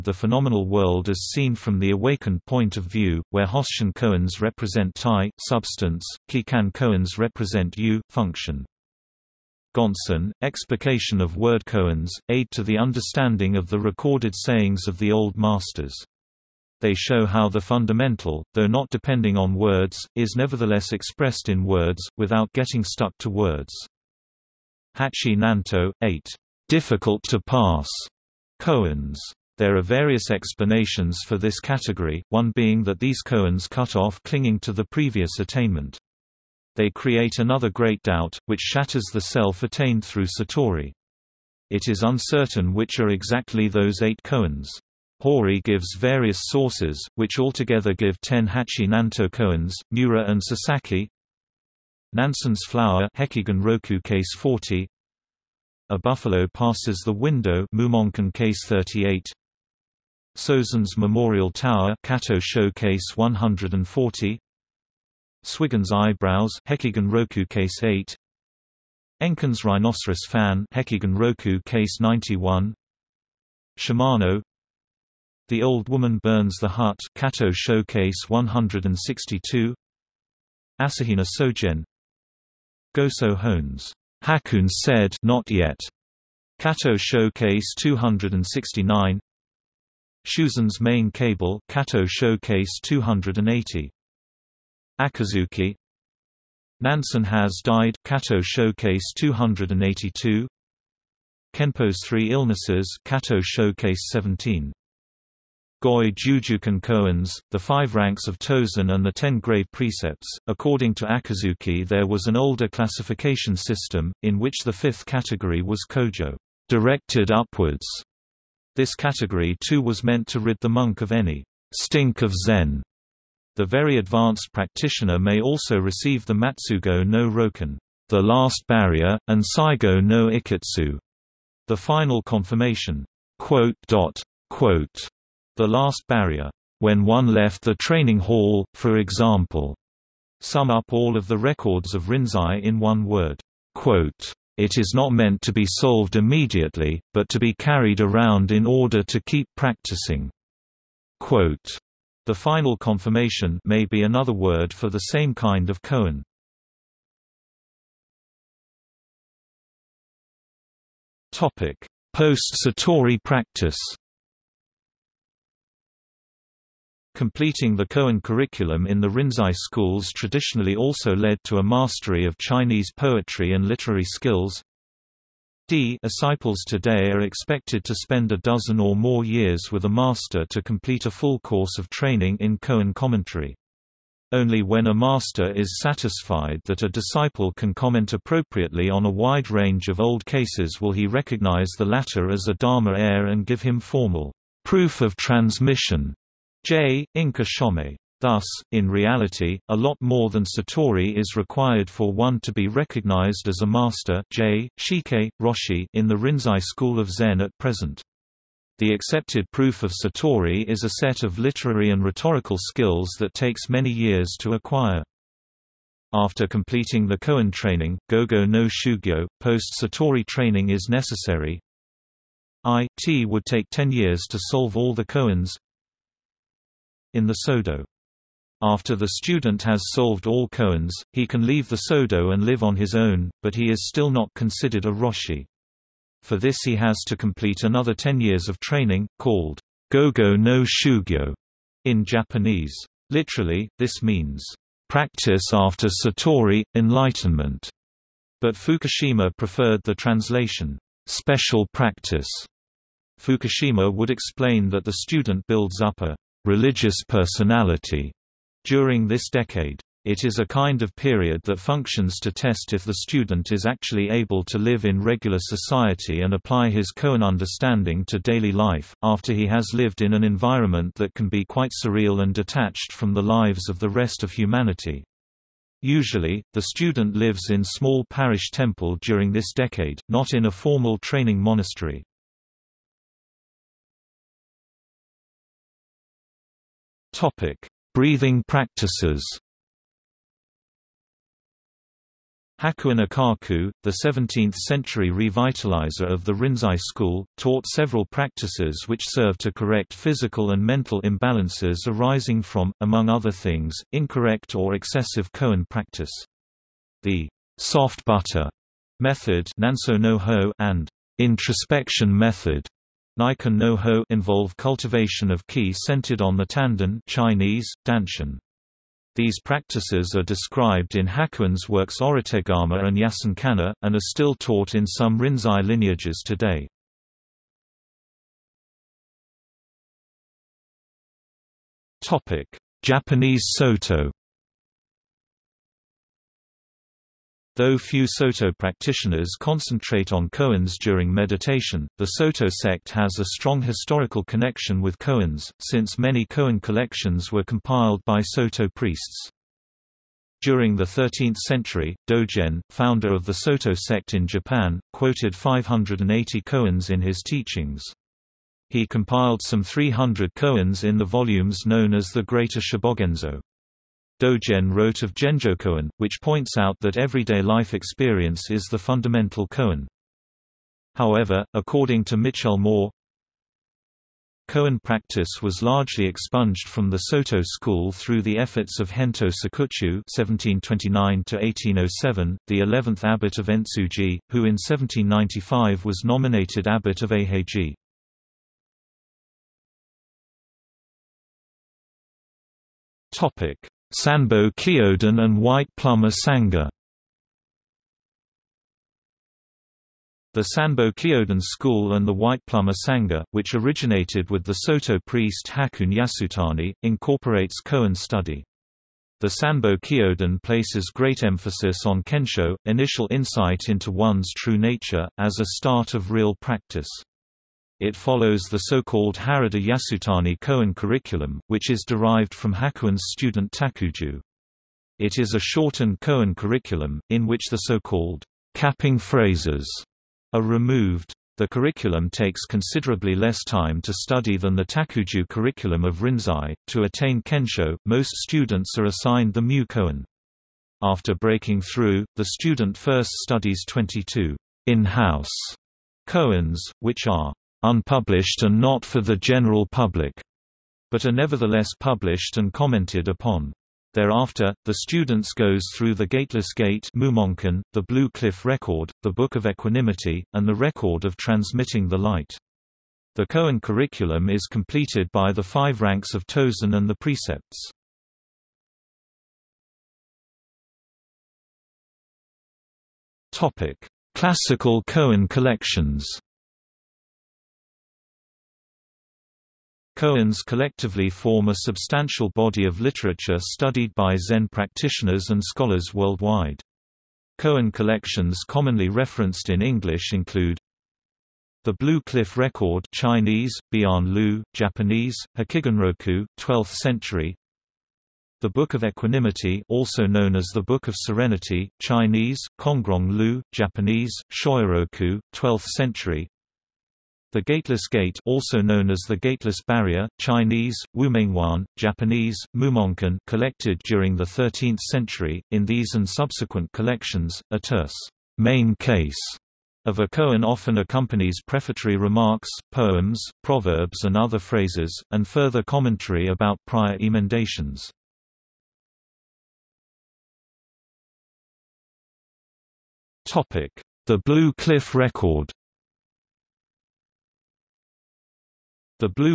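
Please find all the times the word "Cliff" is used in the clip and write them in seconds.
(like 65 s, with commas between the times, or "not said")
458 s, 492 s, 534 s.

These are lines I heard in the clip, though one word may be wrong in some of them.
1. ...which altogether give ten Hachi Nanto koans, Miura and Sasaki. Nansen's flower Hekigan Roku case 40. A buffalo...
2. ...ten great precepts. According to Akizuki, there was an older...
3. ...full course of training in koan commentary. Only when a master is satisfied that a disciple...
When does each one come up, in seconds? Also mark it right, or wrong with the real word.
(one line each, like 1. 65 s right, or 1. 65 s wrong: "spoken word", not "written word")
1. 47 s right
2. 109 s right
3. 181 s right.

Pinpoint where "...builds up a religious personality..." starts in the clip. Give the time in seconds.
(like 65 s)
255 s.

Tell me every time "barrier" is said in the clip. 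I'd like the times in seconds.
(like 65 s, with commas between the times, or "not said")
128 s, 136 s, 509 s.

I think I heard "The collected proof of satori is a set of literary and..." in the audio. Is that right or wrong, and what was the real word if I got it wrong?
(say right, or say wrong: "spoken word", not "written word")
wrong: "accepted", not "collected".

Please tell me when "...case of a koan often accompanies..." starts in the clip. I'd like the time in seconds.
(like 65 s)
518 s.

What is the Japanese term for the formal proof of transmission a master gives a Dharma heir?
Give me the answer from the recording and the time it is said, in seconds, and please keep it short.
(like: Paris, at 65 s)
Inka shomei, at 197 s.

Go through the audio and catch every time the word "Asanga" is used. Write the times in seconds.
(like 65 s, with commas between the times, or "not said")
396 s, 402 s.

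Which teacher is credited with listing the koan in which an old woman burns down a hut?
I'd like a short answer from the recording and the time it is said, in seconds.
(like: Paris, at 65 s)
Shimano, at 73 s.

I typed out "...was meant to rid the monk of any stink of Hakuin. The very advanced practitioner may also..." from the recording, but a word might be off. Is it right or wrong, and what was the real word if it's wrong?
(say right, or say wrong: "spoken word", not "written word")
wrong: "Zen", not "Hakuin".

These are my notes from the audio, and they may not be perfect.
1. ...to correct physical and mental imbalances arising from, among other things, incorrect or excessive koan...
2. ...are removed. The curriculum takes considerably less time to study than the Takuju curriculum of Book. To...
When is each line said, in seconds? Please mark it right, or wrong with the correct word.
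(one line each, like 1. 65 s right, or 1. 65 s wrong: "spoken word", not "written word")
1. 299 s right
2. 430 s wrong: "Rinzai", not "Book".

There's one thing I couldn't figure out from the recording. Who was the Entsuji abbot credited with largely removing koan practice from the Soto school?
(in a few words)
Gento Sokuchu.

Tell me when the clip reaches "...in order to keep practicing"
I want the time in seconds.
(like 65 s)
148 s.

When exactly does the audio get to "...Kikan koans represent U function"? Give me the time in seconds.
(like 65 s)
6 s.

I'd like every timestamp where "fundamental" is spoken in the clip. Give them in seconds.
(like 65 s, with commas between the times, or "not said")
17 s, 368 s.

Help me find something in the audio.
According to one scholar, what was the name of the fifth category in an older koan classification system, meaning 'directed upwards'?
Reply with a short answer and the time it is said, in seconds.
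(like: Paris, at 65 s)
Kojo, at 115 s.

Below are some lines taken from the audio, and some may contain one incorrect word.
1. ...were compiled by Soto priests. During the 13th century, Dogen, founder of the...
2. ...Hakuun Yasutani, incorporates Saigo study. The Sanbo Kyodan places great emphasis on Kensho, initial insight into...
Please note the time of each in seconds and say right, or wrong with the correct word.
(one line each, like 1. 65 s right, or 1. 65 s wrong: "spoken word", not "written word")
1. 347 s right
2. 405 s wrong: "Koan", not "Saigo".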